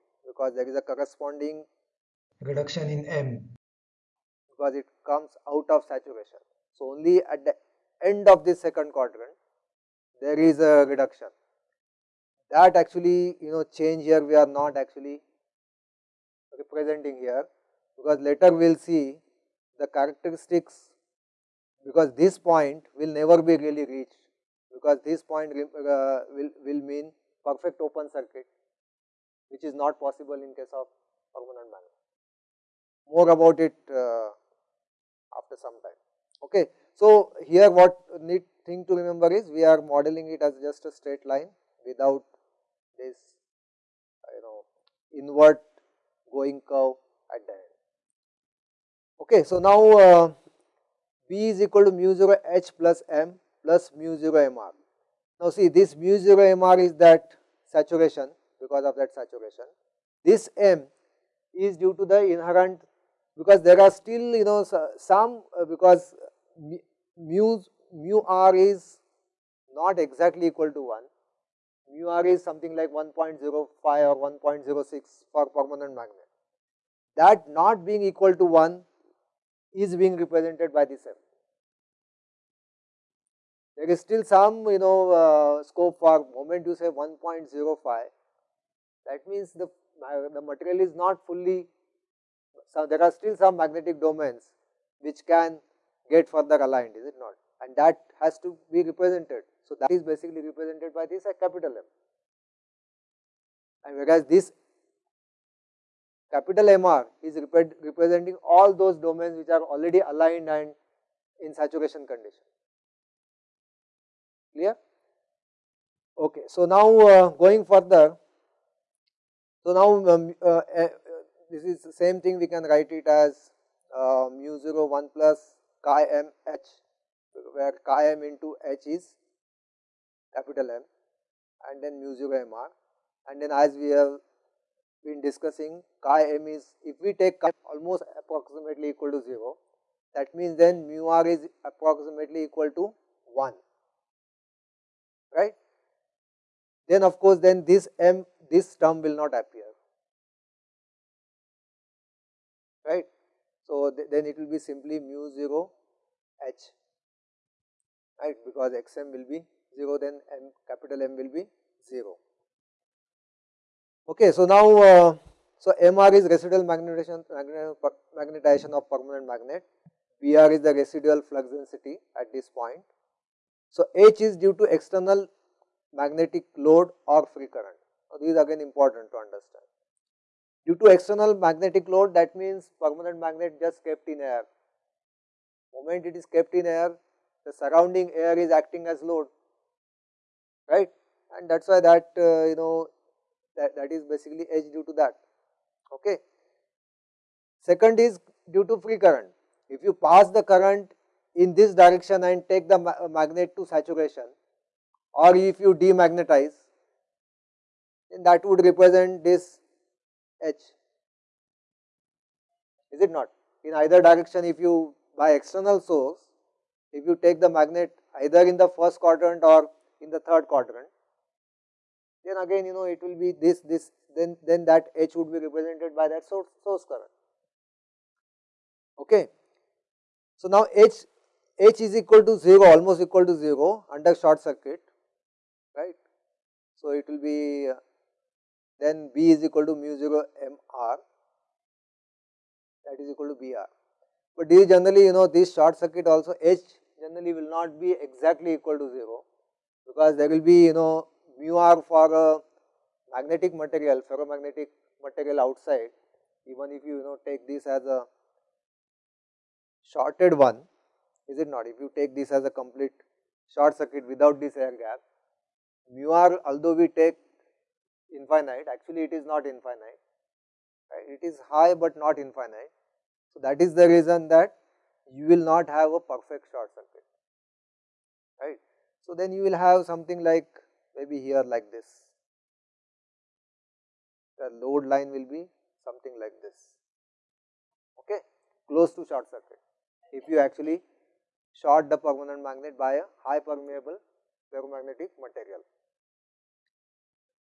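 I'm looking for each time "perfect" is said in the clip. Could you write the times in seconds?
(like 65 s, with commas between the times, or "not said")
27 s, 276 s.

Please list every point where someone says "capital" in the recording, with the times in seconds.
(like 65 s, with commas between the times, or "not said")
101 s, 106 s, 130 s, 160 s.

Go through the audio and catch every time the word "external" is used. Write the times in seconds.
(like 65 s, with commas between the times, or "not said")
174 s, 180 s, 215 s.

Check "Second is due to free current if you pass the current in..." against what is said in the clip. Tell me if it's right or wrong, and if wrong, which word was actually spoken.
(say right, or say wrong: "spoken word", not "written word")
right.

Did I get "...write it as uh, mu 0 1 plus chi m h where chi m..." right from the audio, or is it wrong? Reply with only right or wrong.
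right.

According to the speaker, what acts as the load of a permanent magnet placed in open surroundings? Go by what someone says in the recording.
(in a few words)
the surrounding air.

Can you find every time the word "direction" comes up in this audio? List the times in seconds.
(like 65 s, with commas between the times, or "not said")
201 s, 214 s.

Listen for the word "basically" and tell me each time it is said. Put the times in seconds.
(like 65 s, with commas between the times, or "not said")
100 s, 194 s.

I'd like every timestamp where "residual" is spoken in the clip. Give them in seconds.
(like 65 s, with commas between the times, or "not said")
166 s, 170 s.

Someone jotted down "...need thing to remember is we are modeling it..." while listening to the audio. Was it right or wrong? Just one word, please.
right.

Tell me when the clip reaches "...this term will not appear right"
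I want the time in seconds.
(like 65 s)
148 s.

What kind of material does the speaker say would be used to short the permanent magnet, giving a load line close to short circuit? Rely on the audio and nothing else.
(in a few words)
high permeable ferromagnetic material.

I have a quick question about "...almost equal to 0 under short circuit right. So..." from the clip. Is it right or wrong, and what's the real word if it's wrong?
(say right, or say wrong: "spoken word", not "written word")
right.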